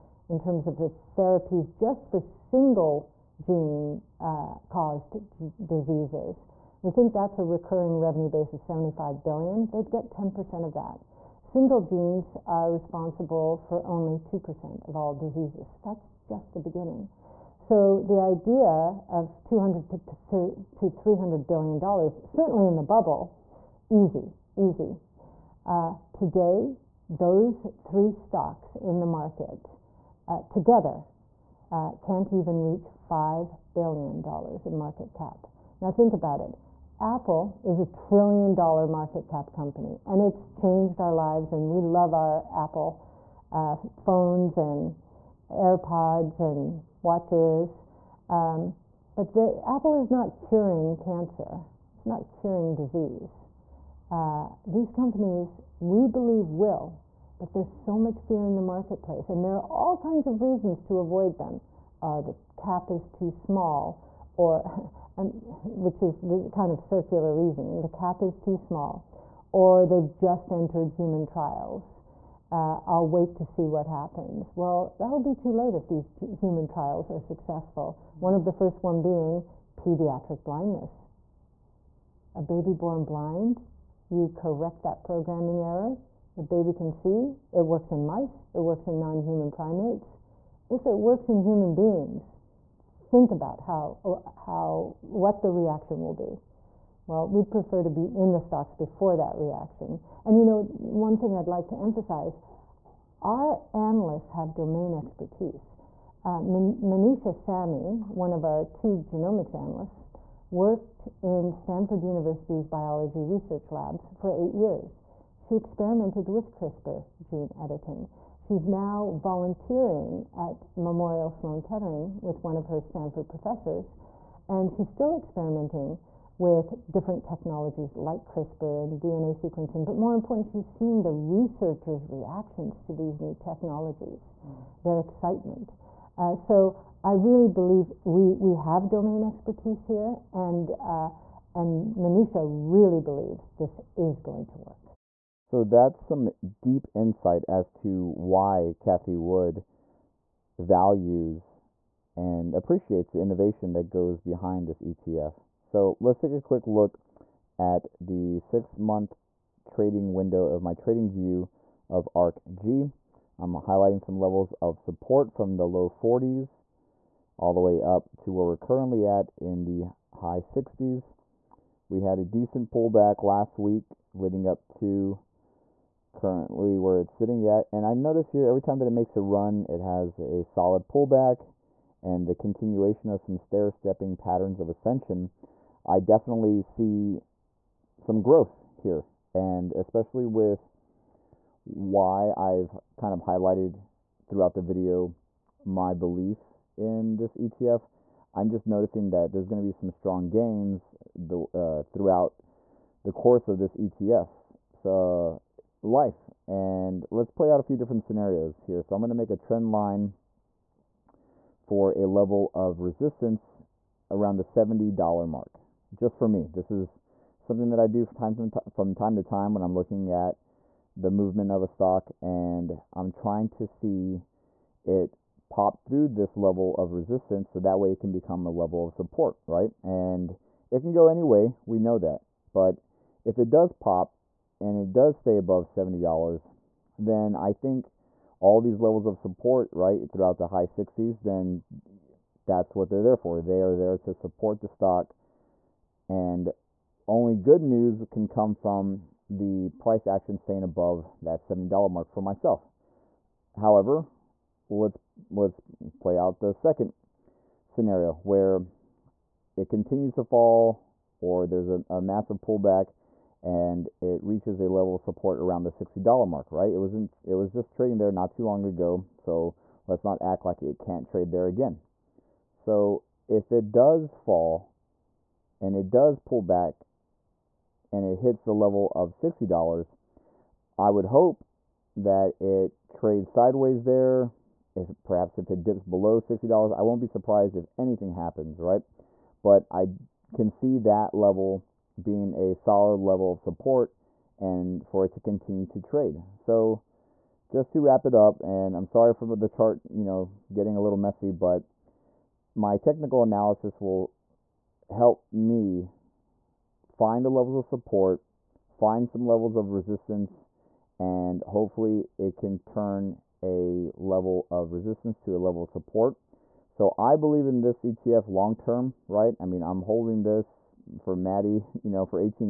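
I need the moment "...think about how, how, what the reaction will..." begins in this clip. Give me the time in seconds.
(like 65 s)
93 s.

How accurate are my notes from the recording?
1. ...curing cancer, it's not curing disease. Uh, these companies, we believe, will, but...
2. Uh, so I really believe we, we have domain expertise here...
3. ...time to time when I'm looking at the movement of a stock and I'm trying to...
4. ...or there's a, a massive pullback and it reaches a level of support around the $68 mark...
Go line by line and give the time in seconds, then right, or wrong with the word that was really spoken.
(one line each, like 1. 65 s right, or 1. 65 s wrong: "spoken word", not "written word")
1. 50 s right
2. 136 s right
3. 218 s right
4. 261 s wrong: "60", not "68".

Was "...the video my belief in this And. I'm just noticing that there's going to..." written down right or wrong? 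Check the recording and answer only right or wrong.
wrong.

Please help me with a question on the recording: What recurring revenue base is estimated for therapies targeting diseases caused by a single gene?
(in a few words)
75 billion.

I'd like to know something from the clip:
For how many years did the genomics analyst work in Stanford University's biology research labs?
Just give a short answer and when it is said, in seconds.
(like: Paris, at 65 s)
8, at 114 s.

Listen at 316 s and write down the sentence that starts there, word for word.
So I believe in this ETF long term, right?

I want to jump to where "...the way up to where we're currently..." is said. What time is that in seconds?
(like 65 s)
167 s.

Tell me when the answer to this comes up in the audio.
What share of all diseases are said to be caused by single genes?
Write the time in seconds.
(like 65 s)
14 s.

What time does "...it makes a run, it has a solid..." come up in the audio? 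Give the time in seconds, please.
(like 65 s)
178 s.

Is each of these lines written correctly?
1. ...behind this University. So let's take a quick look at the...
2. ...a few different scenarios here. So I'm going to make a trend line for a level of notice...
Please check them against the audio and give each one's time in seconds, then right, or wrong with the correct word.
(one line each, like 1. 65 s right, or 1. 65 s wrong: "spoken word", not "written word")
1. 154 s wrong: "ETF", not "University"
2. 207 s wrong: "resistance", not "notice".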